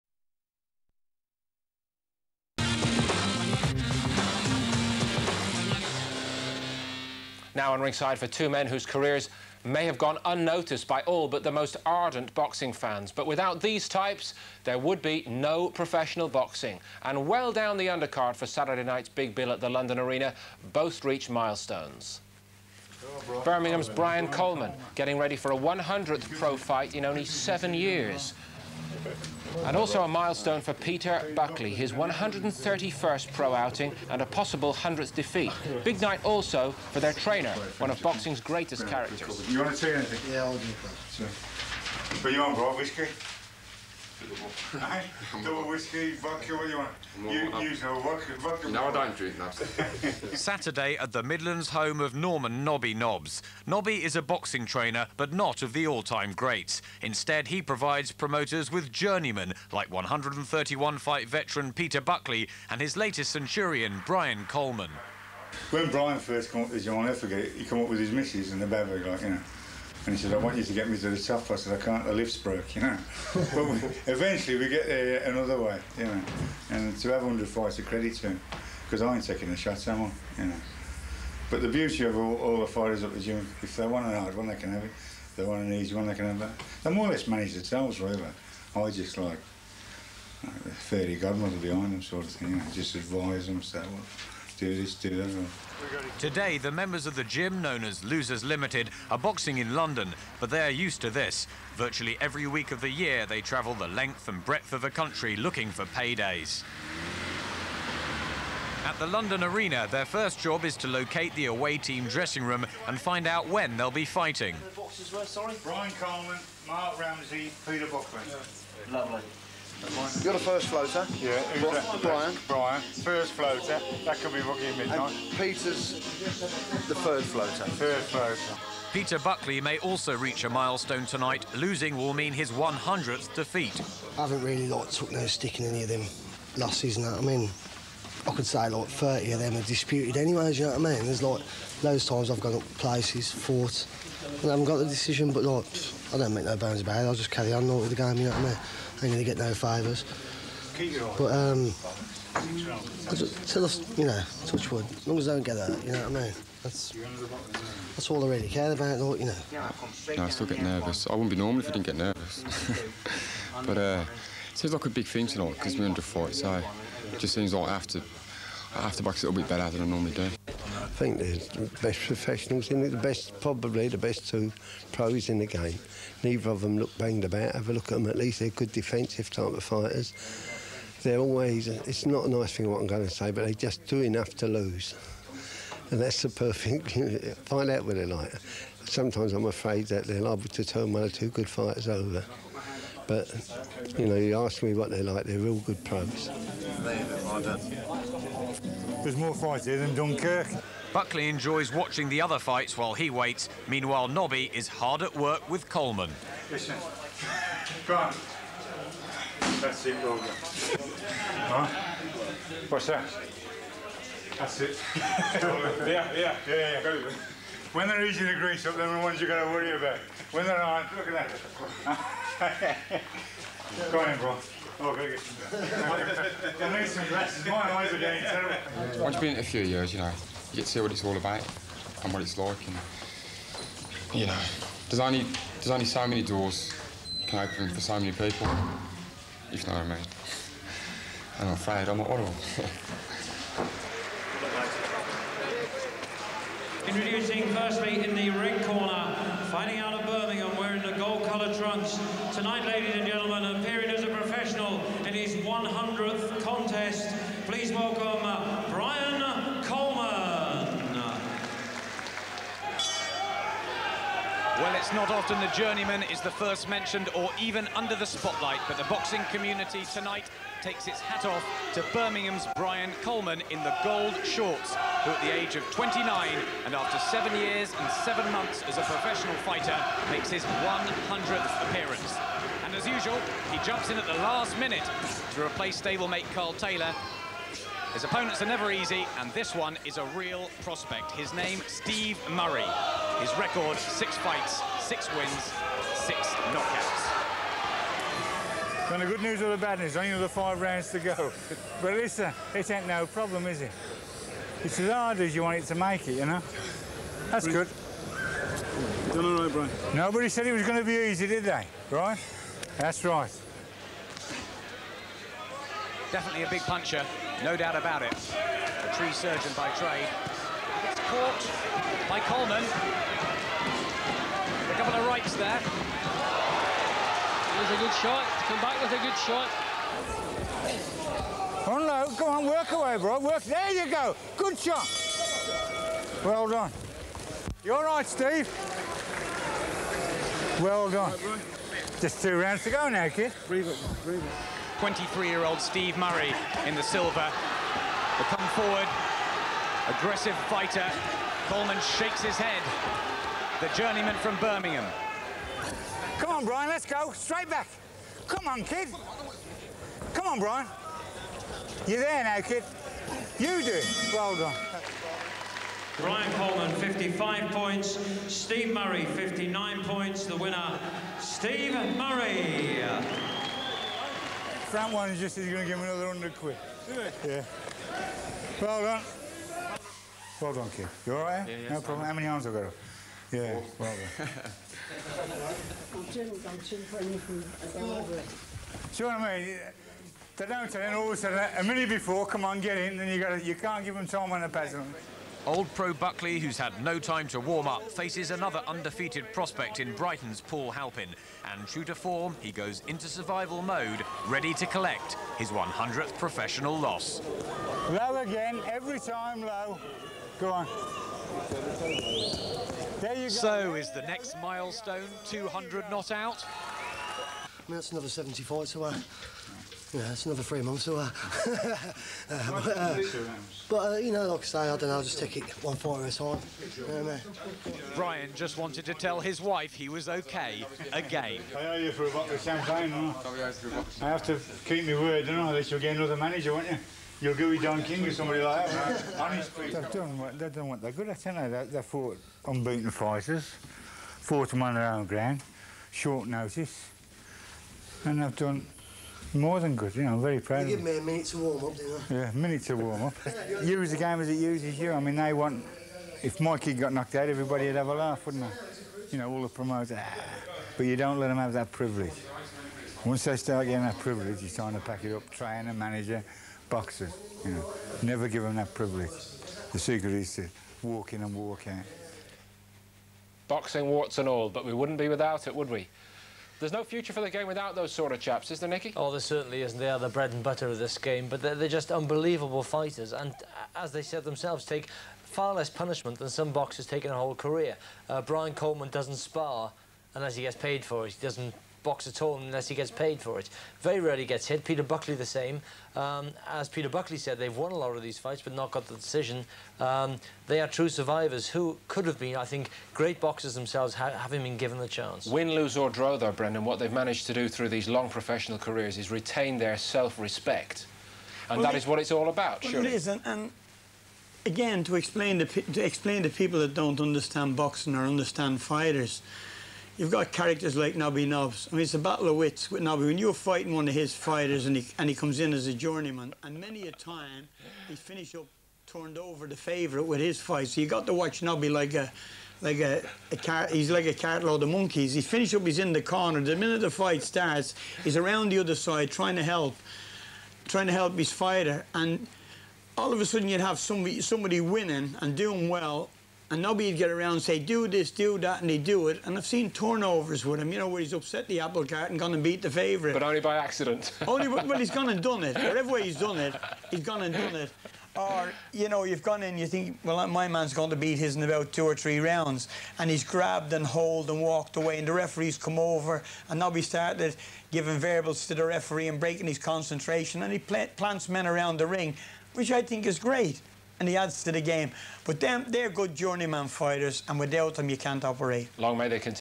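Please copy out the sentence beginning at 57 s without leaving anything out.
Instead, he provides promoters with journeymen, like 131-fight veteran Peter Buckley and his latest centurion, Brian Coleman.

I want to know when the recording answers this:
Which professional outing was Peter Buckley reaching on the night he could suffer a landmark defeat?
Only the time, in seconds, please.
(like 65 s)
31 s.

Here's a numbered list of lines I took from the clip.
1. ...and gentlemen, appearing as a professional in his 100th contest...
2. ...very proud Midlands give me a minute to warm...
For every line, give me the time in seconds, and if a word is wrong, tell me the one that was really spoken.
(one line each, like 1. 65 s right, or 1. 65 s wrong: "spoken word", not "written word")
1. 252 s right
2. 450 s wrong: "You", not "Midlands".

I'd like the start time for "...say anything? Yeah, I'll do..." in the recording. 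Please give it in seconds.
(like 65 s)
39 s.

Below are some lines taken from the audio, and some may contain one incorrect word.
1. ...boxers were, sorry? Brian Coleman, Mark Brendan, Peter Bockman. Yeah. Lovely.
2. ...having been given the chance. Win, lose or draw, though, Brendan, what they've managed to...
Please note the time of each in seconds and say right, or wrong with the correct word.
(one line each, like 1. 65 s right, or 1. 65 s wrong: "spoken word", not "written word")
1. 114 s wrong: "Ramsey", not "Brendan"
2. 504 s right.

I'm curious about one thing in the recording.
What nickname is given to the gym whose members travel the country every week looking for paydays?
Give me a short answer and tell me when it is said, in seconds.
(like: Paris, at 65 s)
Losers Limited, at 98 s.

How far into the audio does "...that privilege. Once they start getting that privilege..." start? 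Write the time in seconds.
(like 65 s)
461 s.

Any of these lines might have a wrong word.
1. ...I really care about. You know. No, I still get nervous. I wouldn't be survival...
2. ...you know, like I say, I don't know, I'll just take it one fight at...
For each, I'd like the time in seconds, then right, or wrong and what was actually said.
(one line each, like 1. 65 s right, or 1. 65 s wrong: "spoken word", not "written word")
1. 158 s wrong: "normal", not "survival"
2. 423 s right.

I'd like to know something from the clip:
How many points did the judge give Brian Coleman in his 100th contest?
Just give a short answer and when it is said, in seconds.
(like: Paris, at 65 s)
55, at 366 s.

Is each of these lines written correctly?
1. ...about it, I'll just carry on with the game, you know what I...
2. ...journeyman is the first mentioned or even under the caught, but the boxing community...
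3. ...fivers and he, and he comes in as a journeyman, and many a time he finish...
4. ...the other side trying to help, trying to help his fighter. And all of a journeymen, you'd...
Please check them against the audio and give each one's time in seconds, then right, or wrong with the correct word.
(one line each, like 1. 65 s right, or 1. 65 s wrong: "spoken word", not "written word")
1. 146 s right
2. 265 s wrong: "spotlight", not "caught"
3. 524 s wrong: "fighters", not "fivers"
4. 538 s wrong: "sudden", not "journeymen".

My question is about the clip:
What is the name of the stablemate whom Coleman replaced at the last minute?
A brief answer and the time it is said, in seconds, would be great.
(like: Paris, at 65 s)
Carl Taylor, at 286 s.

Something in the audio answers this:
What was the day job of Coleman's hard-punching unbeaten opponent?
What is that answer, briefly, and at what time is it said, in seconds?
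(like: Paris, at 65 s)
Tree surgeon, at 318 s.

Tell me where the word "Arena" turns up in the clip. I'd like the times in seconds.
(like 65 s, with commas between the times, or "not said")
19 s, 109 s.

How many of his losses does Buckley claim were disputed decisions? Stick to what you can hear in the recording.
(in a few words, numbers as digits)
30.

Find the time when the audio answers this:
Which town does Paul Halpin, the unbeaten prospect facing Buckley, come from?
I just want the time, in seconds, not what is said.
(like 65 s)
399 s.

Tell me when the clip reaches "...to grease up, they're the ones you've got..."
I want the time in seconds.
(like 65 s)
218 s.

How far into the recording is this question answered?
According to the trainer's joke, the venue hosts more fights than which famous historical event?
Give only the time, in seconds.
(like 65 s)
199 s.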